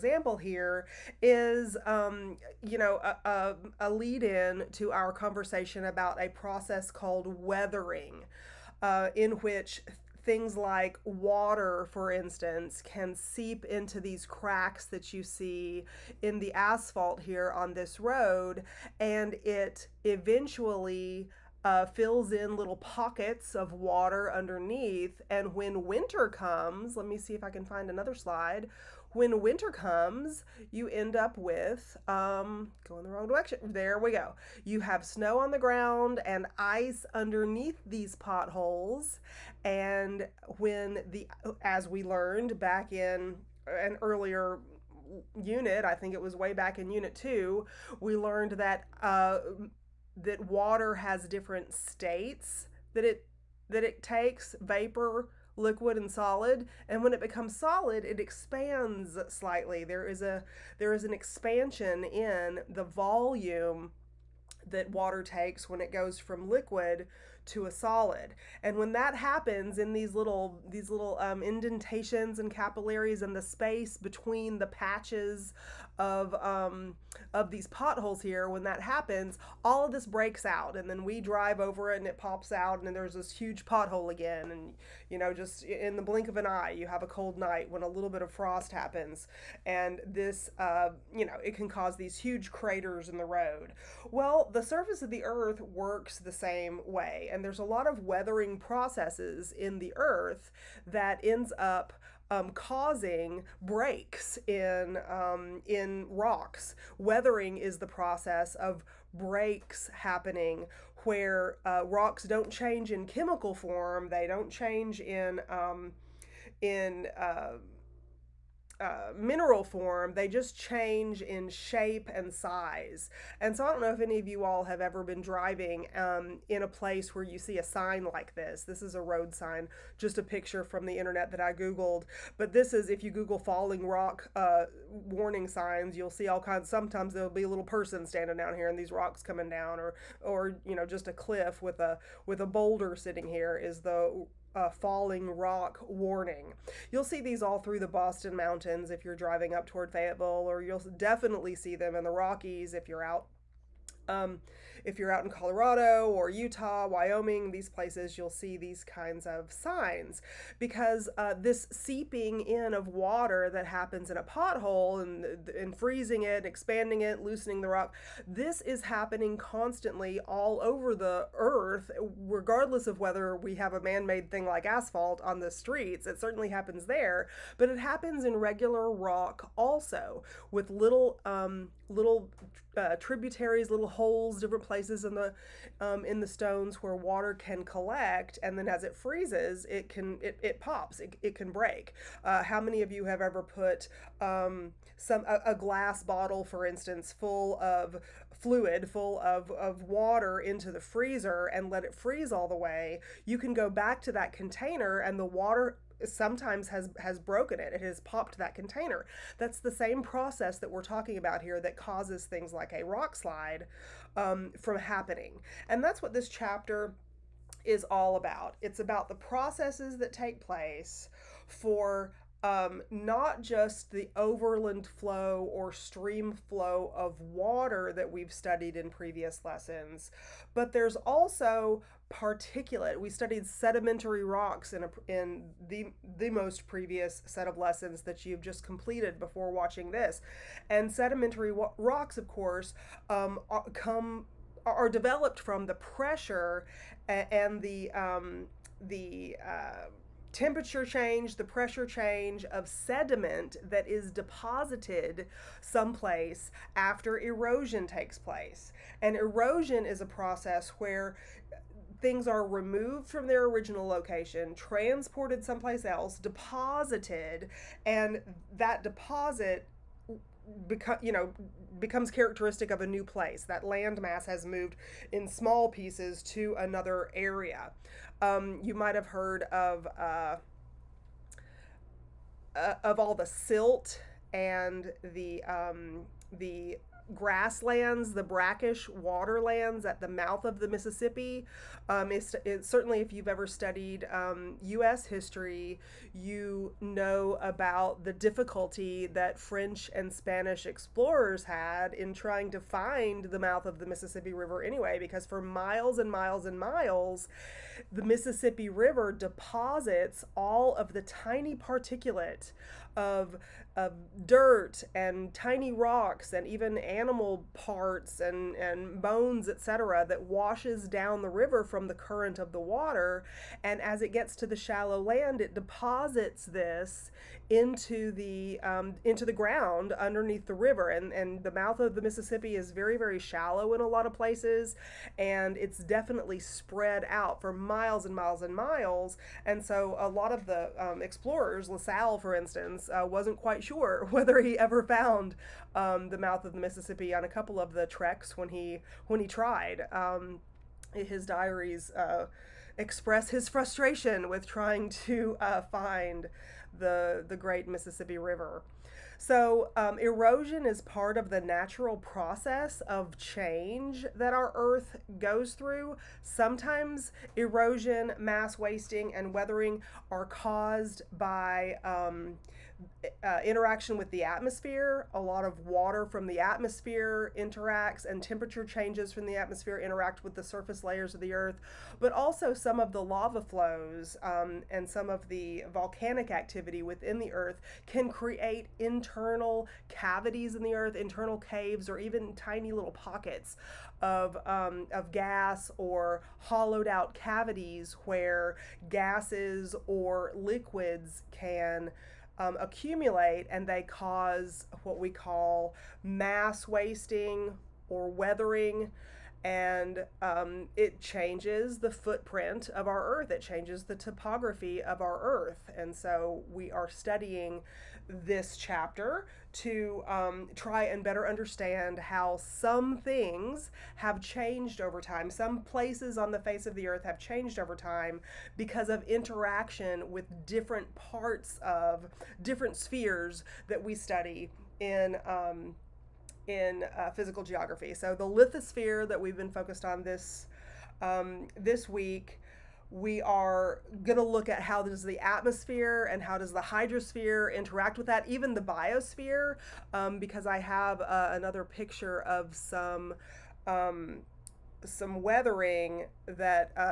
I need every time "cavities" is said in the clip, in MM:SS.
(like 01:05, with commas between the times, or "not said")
06:29, 06:37.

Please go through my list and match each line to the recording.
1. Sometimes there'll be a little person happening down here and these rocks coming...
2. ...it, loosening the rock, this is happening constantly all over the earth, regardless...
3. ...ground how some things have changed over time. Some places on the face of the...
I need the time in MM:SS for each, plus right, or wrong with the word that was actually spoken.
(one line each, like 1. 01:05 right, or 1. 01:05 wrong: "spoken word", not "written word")
1. 02:16 wrong: "standing", not "happening"
2. 02:47 right
3. 07:01 wrong: "understand", not "ground".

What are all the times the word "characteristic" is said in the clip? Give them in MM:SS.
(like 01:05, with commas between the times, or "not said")
04:32.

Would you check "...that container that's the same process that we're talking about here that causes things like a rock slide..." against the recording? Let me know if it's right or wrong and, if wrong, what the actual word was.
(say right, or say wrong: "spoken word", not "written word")
right.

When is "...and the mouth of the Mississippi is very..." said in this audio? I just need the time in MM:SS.
05:31.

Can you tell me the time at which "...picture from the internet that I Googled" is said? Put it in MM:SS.
02:10.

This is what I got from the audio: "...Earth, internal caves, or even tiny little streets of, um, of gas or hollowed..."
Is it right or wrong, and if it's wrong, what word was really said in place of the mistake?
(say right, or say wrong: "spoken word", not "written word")
wrong: "pockets", not "streets".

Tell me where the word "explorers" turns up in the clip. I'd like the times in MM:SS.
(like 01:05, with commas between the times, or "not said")
05:00, 05:41.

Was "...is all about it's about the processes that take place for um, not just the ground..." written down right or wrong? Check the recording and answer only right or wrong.
wrong.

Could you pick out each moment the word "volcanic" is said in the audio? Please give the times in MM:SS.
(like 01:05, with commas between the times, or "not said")
06:25.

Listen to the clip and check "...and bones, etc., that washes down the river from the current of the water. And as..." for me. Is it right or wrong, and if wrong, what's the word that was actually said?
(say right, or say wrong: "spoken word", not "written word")
right.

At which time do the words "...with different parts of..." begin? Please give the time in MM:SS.
07:10.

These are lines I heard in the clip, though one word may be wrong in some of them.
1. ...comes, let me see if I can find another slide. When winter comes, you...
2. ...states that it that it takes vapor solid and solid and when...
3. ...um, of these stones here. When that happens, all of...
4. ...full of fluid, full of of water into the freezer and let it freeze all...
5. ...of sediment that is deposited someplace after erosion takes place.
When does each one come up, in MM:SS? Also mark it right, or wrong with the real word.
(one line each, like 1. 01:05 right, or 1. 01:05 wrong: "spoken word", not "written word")
1. 00:26 right
2. 00:51 wrong: "liquid", not "solid"
3. 01:16 wrong: "potholes", not "stones"
4. 03:17 right
5. 04:12 right.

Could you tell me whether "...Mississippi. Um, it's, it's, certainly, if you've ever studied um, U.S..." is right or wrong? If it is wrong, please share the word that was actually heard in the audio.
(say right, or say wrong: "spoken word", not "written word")
right.